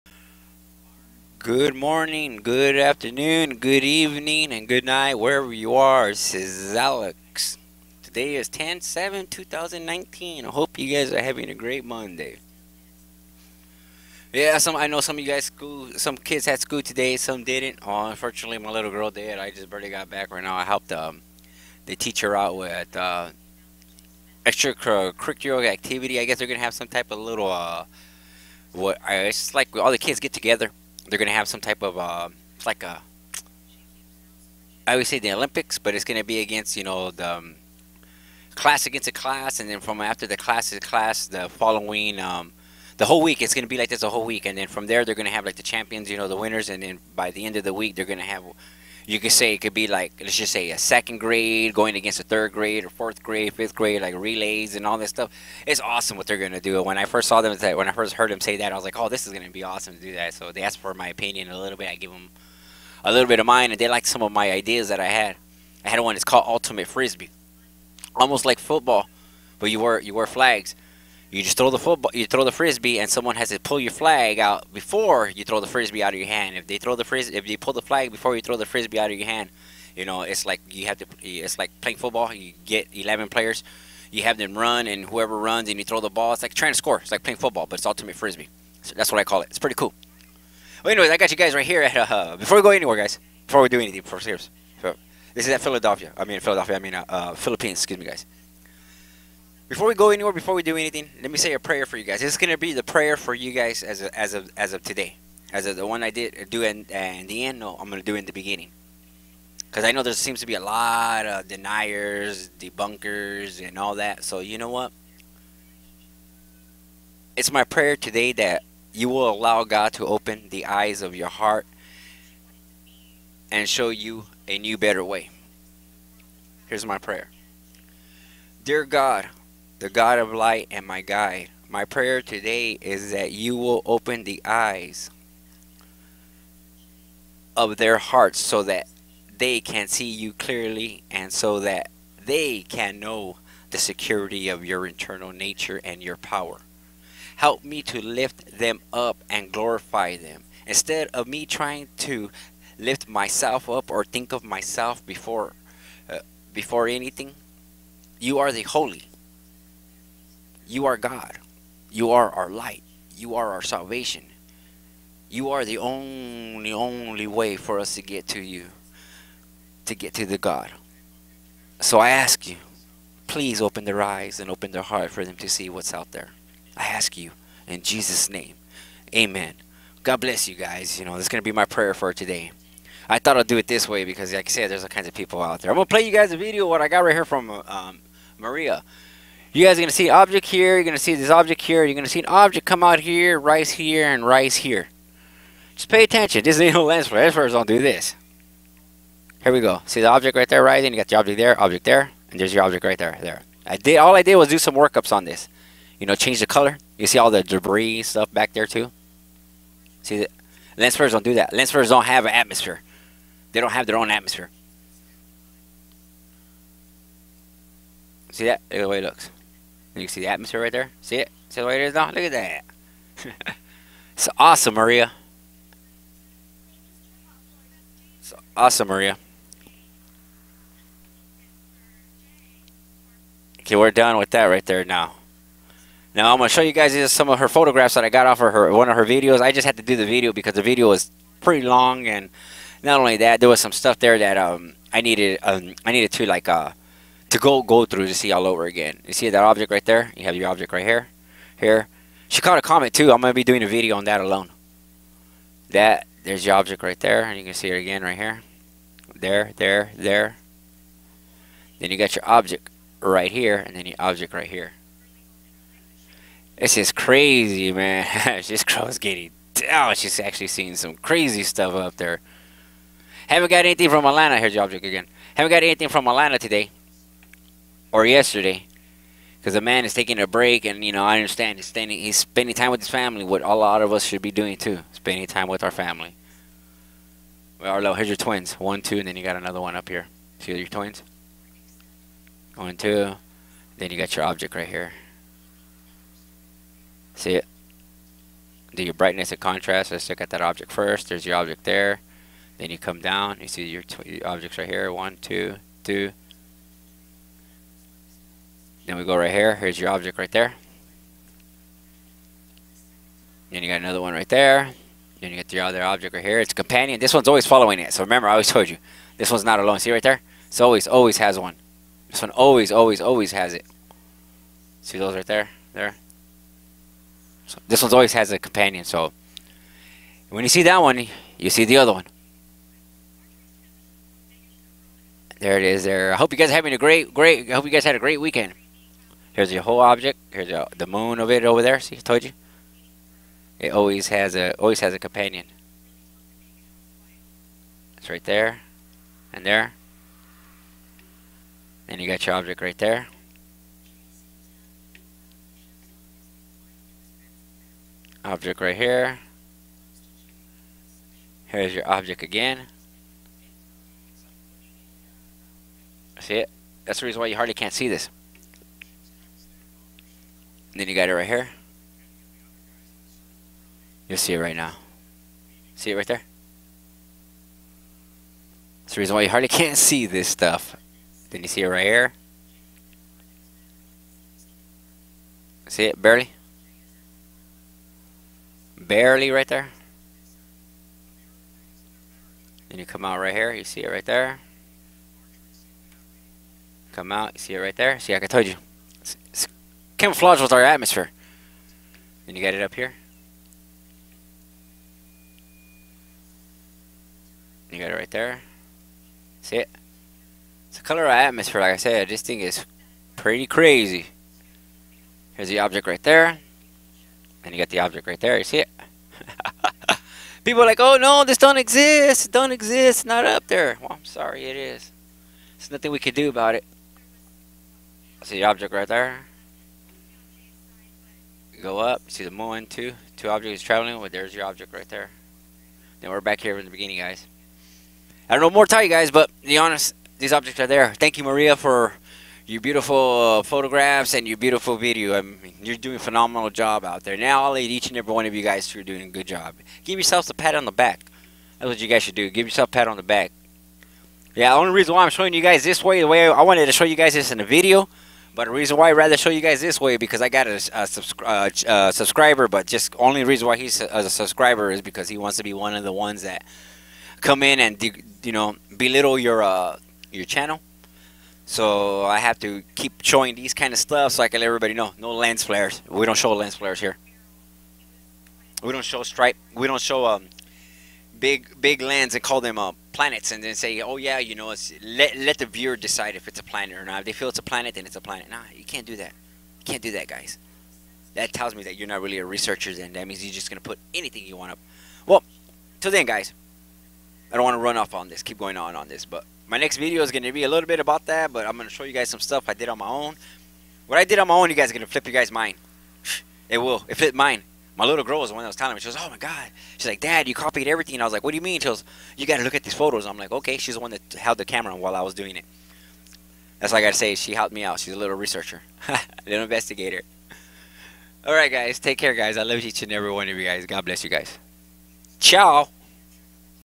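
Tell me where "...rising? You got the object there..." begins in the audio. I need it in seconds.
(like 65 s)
200 s.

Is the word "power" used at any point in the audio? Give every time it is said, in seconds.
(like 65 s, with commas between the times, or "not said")
146 s.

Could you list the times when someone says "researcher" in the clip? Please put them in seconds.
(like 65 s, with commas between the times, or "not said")
492 s, 518 s.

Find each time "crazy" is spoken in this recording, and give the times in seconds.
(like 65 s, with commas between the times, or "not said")
266 s, 270 s, 413 s.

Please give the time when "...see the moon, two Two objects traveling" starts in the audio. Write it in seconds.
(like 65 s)
432 s.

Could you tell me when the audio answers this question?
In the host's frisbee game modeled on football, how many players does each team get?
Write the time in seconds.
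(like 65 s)
82 s.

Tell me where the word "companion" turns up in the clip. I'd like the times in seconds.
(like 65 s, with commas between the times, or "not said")
316 s, 328 s, 344 s.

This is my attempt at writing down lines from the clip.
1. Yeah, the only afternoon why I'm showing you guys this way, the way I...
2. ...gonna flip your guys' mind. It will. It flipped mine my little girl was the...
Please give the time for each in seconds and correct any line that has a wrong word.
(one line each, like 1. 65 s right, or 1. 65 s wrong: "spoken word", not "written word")
1. 454 s wrong: "reason", not "afternoon"
2. 504 s right.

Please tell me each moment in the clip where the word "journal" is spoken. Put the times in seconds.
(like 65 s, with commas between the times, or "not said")
not said.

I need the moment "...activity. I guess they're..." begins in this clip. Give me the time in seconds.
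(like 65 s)
25 s.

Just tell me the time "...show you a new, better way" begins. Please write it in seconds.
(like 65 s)
123 s.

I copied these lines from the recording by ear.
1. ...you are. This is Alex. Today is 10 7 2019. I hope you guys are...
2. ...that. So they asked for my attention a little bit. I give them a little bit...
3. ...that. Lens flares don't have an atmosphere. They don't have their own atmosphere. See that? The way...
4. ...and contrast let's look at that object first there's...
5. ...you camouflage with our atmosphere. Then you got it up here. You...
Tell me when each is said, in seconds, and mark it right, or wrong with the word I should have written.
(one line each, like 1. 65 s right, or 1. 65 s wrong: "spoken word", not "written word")
1. 5 s right
2. 60 s wrong: "opinion", not "attention"
3. 211 s right
4. 299 s right
5. 398 s right.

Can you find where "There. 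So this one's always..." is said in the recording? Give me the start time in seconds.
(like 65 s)
325 s.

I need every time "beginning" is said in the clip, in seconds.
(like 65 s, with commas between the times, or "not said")
108 s, 436 s.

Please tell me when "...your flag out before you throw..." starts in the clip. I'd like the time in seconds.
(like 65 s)
73 s.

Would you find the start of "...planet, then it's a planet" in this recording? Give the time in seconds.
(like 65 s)
487 s.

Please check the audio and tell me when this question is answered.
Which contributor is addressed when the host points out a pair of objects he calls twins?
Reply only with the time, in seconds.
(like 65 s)
287 s.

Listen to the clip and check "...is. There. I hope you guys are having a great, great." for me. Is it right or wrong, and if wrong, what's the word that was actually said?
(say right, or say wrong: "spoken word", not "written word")
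right.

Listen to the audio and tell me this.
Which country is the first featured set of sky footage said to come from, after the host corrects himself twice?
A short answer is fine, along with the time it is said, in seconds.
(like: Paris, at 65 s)
Philippines, at 97 s.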